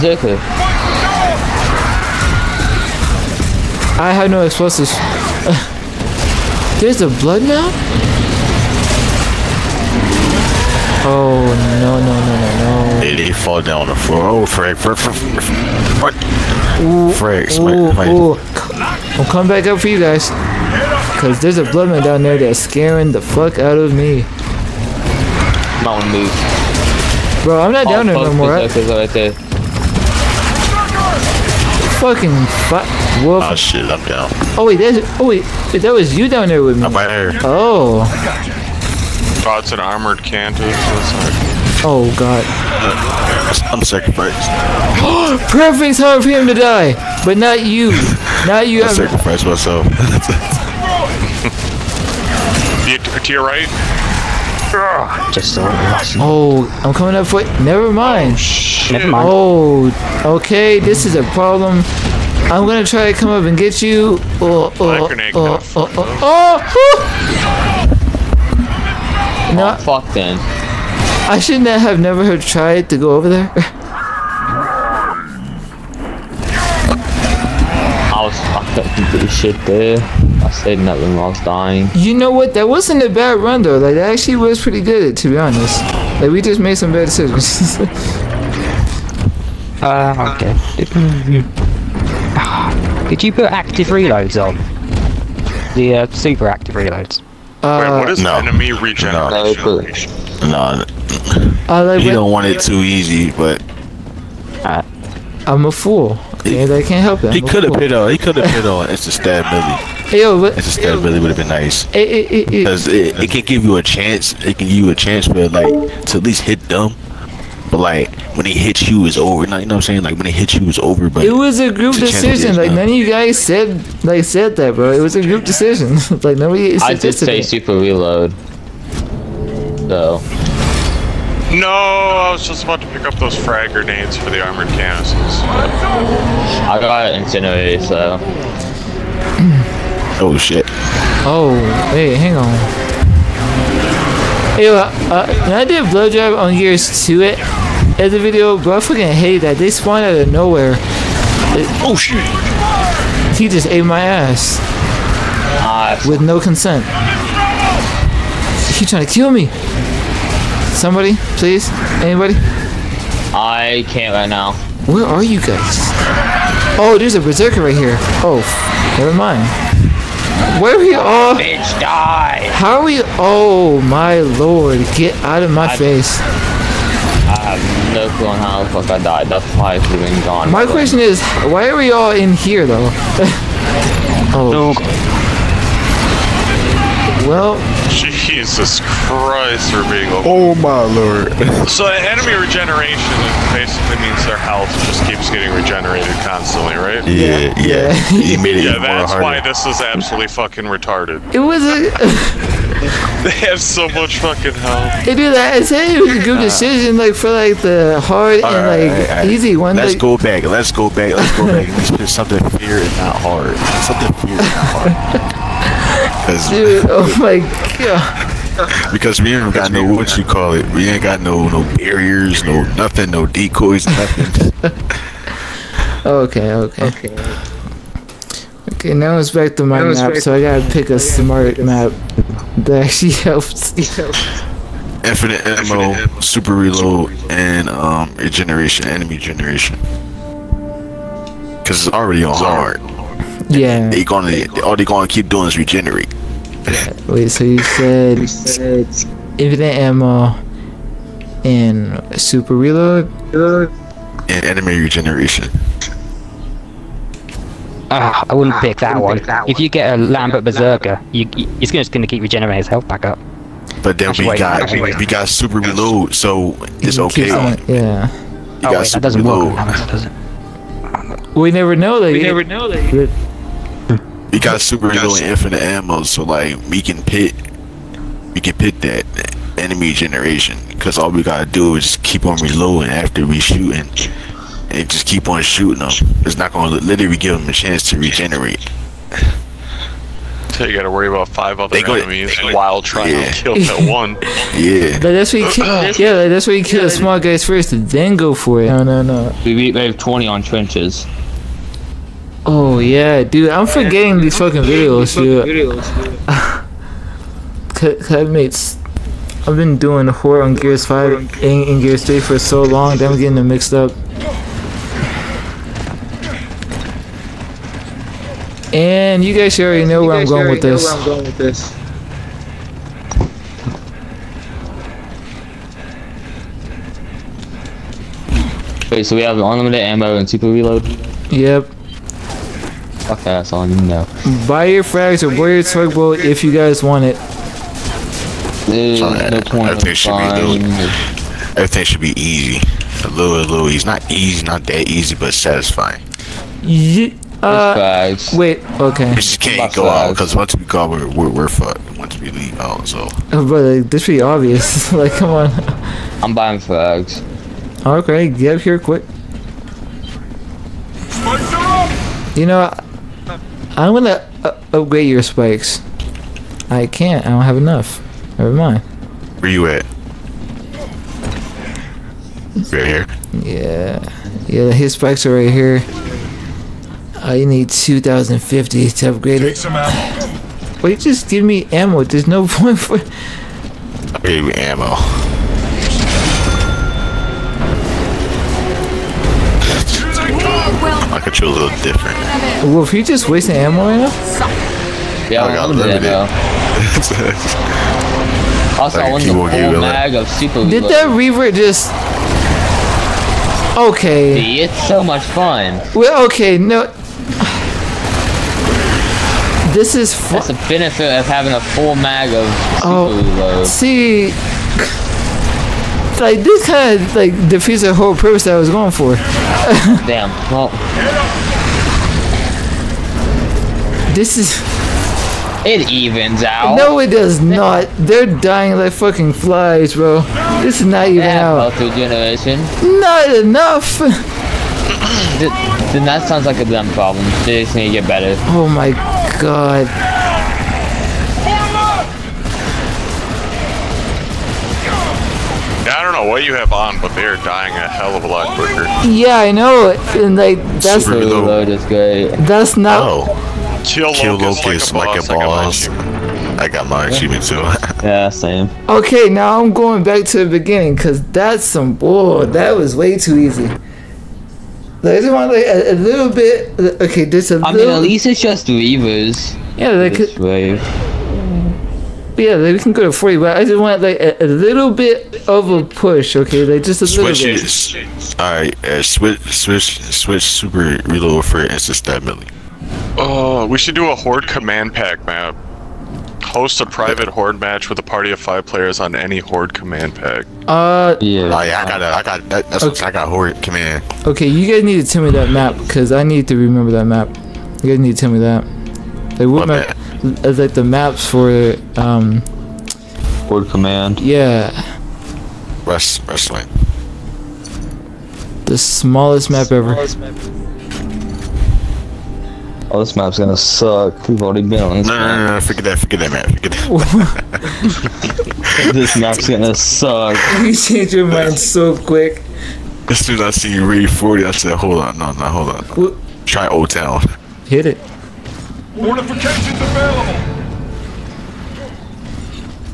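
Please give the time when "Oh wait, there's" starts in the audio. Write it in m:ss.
0:34.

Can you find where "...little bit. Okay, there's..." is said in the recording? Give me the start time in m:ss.
7:45.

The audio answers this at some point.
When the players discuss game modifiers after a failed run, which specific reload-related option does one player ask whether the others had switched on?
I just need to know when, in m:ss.
1:36.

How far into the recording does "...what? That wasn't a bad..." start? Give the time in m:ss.
1:22.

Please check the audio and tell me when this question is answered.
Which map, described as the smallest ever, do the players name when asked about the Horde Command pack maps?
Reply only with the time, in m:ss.
8:26.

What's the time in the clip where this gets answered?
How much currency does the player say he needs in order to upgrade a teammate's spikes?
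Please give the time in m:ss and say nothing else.
6:17.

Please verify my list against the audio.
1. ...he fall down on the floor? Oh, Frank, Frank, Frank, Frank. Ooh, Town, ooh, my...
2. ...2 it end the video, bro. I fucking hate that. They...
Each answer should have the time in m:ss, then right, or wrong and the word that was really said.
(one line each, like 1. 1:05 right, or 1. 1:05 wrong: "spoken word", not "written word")
1. 0:13 wrong: "Frank", not "Town"
2. 2:27 right.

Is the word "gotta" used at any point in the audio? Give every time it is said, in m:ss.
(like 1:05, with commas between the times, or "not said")
3:50, 4:41.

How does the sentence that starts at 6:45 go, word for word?
Well, okay, no, this is That's the benefit of having a full mag of oh, reload.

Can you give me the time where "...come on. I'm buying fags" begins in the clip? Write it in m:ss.
5:55.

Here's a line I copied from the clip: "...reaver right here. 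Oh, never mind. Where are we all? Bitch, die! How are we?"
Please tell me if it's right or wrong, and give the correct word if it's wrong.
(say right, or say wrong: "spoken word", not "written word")
wrong: "berserker", not "reaver".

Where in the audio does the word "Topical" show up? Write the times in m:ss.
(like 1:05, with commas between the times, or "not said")
not said.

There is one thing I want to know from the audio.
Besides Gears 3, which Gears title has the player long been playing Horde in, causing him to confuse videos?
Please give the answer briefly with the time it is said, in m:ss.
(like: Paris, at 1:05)
Gears 5, at 5:10.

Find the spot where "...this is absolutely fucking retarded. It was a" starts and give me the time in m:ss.
3:19.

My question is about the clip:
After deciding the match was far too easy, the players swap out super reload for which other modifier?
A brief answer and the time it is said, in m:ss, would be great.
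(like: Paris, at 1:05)
Instant stab melee, at 8:01.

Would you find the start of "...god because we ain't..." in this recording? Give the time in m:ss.
3:37.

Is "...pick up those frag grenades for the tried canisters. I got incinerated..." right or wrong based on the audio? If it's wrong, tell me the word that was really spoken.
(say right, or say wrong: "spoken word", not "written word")
wrong: "armored", not "tried".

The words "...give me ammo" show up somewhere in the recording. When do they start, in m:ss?
6:21.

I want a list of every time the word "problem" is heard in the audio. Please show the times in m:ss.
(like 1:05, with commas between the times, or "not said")
1:01, 7:16.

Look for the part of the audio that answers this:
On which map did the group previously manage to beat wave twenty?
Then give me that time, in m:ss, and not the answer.
5:00.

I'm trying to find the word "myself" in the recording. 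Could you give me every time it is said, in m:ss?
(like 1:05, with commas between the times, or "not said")
0:49.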